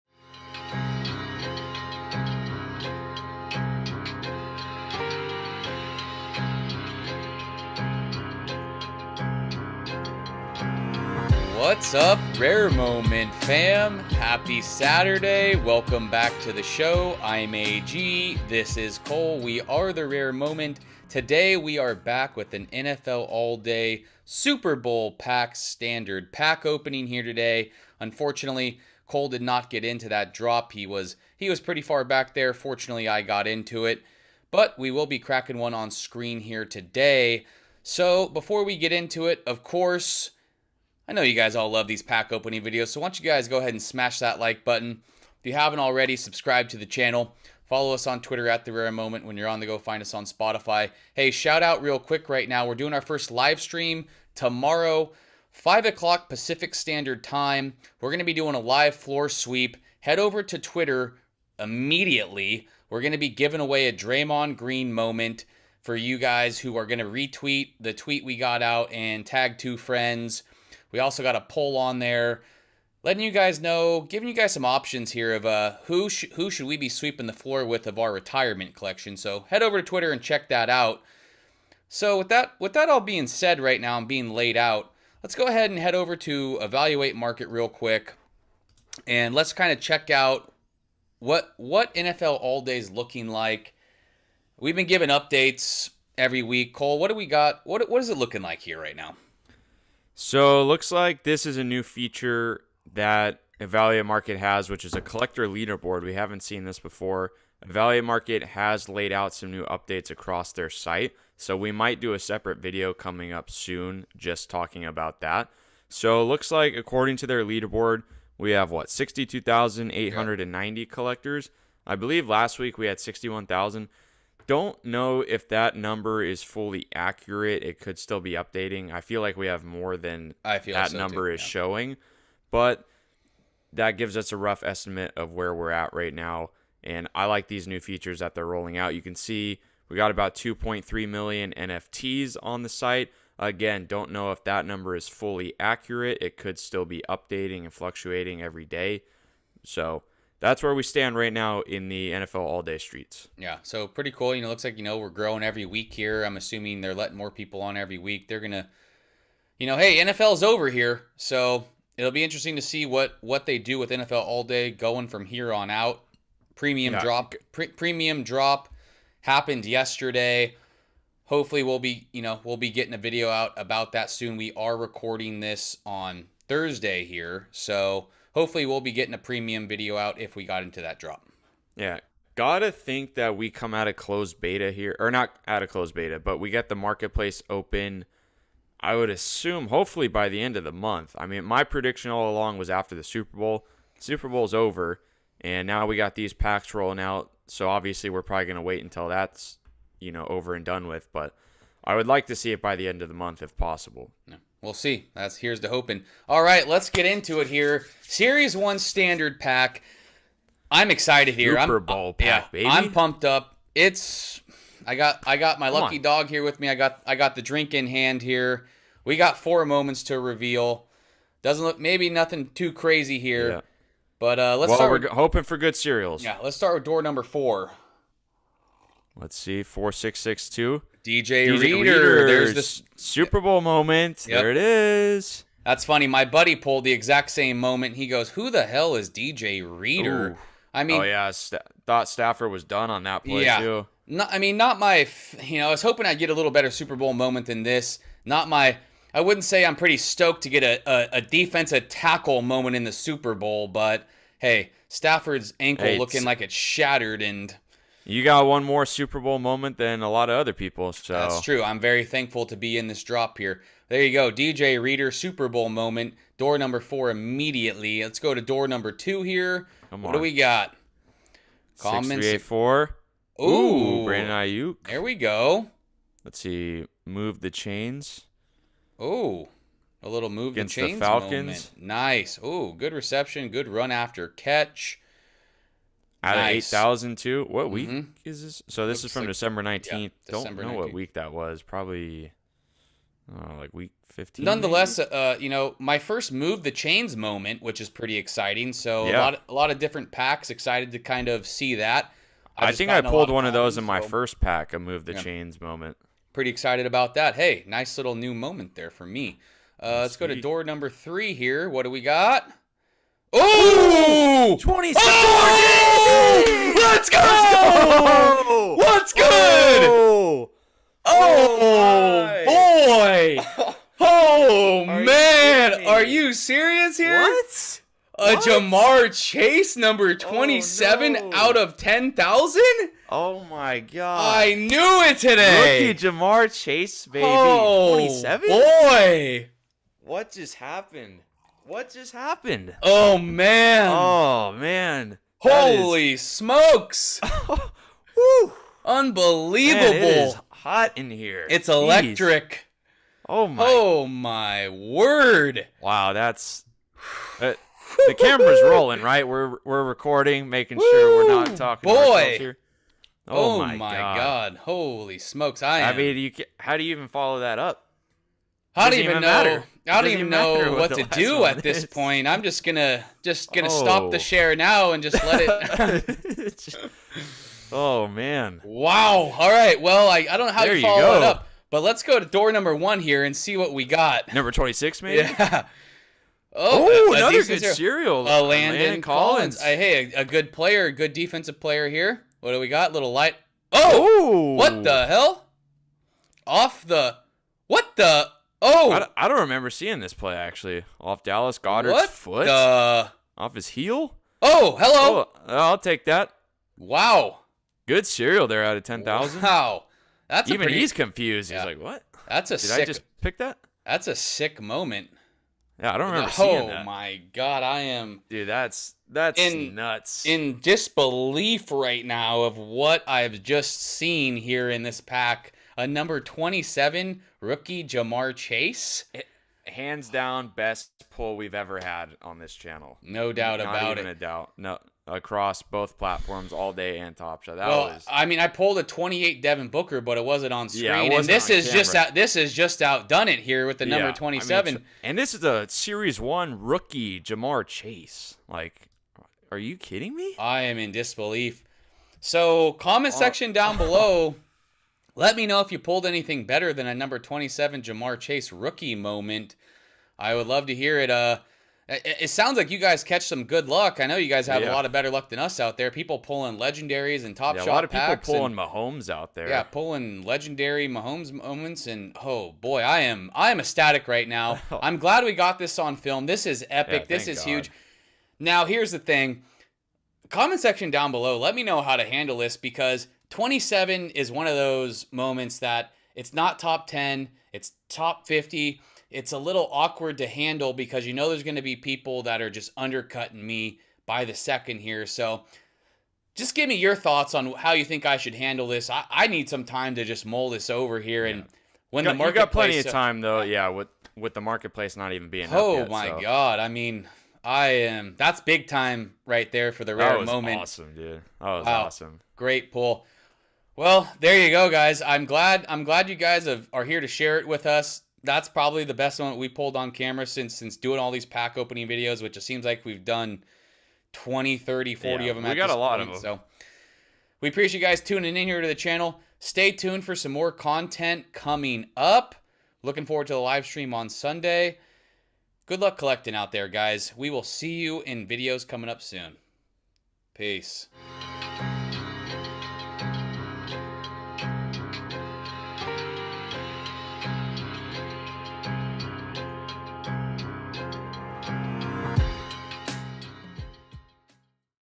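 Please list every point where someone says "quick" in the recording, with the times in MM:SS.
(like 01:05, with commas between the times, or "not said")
00:51, 01:27.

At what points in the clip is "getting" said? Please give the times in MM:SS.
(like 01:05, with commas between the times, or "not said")
02:52, 02:58.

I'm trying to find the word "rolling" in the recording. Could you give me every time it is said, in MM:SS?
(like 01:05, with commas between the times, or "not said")
02:18, 03:16, 05:58.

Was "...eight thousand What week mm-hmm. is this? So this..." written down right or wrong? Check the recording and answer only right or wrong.
right.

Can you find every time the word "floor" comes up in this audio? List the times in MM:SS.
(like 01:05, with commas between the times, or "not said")
00:58, 01:17.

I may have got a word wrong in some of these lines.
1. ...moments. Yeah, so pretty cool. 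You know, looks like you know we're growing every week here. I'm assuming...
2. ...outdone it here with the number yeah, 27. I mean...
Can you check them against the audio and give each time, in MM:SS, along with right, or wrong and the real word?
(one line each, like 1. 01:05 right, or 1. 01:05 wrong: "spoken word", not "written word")
1. 02:32 wrong: "streets", not "moments"
2. 07:22 right.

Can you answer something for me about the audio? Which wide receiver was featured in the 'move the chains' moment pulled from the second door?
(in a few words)
Brandon Aiyuk.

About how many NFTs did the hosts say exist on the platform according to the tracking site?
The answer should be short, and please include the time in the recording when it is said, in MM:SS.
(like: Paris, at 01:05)
2.3 million, at 02:20.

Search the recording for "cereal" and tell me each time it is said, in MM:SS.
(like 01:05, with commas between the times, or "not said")
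03:45, 06:27, 06:48.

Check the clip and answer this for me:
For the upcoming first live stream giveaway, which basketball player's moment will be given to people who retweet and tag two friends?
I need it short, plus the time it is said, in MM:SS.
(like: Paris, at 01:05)
Draymond Green, at 01:03.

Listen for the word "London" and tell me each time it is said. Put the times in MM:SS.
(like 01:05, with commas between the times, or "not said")
not said.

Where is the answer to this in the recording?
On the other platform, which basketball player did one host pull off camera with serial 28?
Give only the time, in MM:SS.
07:19.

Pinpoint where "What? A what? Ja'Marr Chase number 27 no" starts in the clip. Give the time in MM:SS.
05:27.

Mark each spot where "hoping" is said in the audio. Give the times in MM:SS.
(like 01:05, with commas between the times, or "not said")
03:25, 03:45, 04:05.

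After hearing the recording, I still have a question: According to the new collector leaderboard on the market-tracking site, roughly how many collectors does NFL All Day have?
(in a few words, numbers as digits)
62,890.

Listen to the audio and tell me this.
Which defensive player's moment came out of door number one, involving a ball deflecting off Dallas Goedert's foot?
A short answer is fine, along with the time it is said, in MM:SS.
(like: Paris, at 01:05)
Landon Collins, at 06:28.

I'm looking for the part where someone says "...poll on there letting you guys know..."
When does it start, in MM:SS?
01:11.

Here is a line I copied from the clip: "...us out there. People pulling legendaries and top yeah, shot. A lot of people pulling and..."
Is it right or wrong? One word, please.
right.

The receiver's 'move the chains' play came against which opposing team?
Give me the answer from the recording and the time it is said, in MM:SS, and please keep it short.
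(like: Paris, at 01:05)
Falcons, at 04:41.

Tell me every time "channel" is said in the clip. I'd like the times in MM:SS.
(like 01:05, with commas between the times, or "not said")
00:46, 07:12, 08:48.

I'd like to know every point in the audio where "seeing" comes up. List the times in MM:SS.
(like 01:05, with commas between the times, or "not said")
06:39, 06:56.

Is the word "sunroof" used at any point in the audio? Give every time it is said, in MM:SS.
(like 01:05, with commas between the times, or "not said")
not said.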